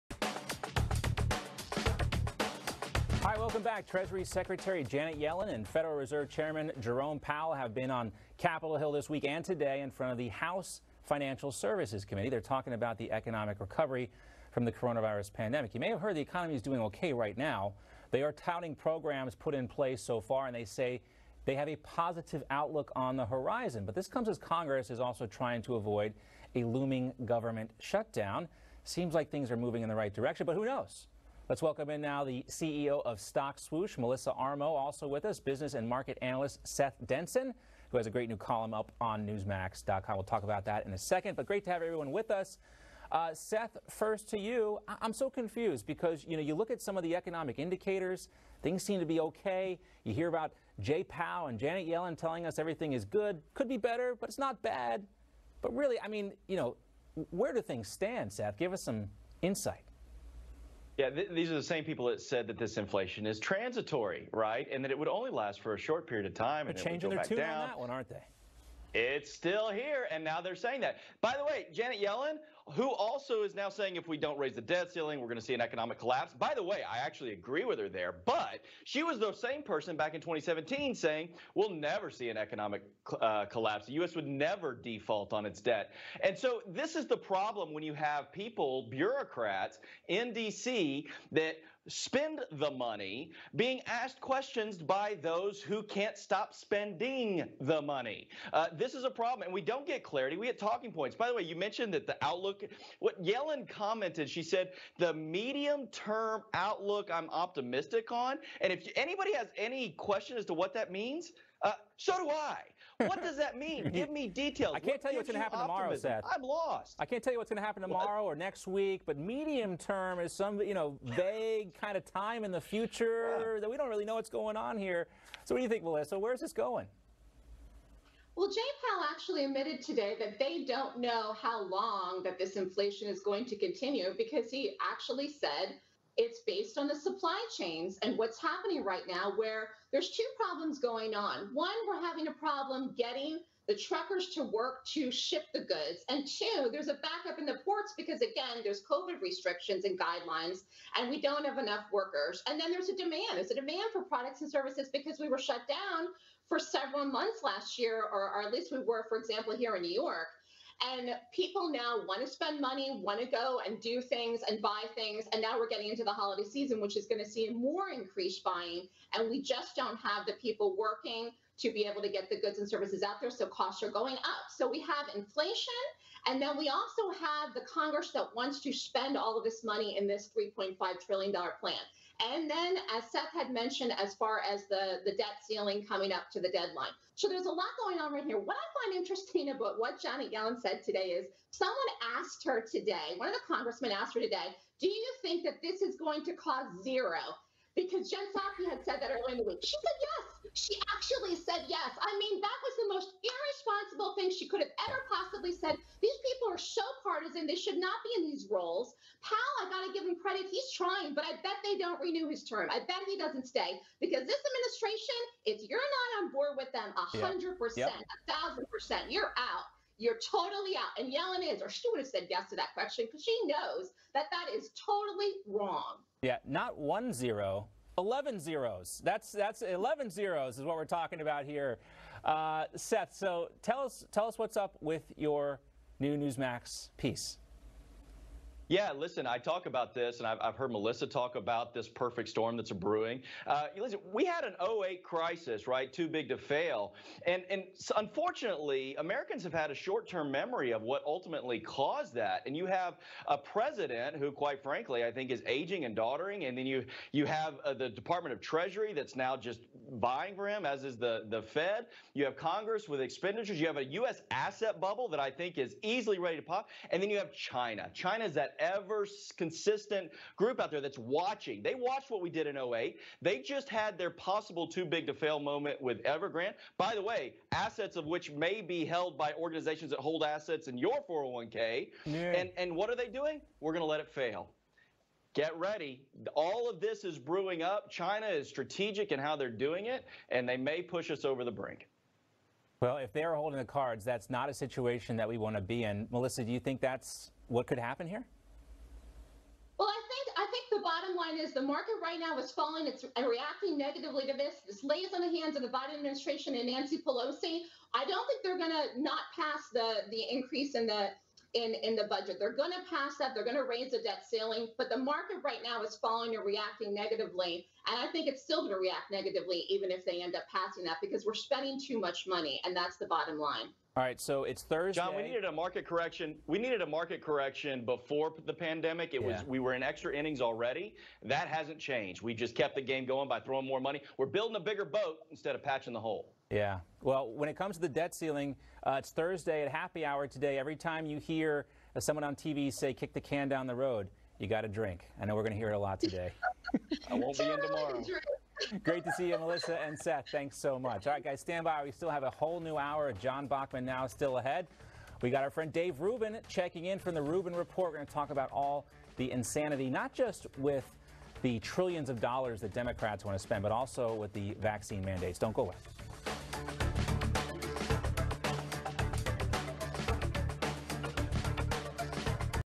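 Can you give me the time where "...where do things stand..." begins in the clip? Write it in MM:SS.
00:57.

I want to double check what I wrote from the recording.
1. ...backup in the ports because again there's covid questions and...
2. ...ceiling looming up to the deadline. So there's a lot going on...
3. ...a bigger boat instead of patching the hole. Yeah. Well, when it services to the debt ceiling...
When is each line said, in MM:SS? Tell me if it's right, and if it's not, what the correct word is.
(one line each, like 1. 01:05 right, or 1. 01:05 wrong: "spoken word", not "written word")
1. 02:26 wrong: "restrictions", not "questions"
2. 03:05 wrong: "coming", not "looming"
3. 05:34 wrong: "comes", not "services".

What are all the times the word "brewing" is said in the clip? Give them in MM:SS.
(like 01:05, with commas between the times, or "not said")
04:02, 04:47.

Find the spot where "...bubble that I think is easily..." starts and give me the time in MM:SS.
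04:24.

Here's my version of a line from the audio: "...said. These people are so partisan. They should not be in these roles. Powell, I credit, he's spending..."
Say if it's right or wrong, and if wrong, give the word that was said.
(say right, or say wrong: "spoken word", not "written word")
wrong: "trying", not "spending".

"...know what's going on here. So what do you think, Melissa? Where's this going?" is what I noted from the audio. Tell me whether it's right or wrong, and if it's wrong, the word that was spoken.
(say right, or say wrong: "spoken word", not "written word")
right.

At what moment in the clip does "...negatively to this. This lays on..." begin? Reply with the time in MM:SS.
05:03.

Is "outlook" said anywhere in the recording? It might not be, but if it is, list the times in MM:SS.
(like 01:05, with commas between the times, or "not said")
00:22, 01:42, 01:46.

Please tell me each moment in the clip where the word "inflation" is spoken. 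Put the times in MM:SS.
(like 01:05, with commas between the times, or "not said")
01:02, 02:12, 02:55.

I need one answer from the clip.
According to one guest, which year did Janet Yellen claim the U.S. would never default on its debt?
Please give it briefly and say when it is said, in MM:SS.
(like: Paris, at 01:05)
2017, at 01:20.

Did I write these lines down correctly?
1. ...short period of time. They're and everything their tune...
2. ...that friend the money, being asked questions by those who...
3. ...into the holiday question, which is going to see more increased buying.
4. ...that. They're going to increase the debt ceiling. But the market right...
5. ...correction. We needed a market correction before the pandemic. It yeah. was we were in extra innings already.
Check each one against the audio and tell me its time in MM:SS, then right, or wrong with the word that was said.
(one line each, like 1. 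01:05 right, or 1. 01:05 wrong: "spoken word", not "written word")
1. 01:05 wrong: "changing", not "everything"
2. 01:31 wrong: "spend", not "friend"
3. 02:45 wrong: "season", not "question"
4. 05:13 wrong: "raise", not "increase"
5. 05:25 right.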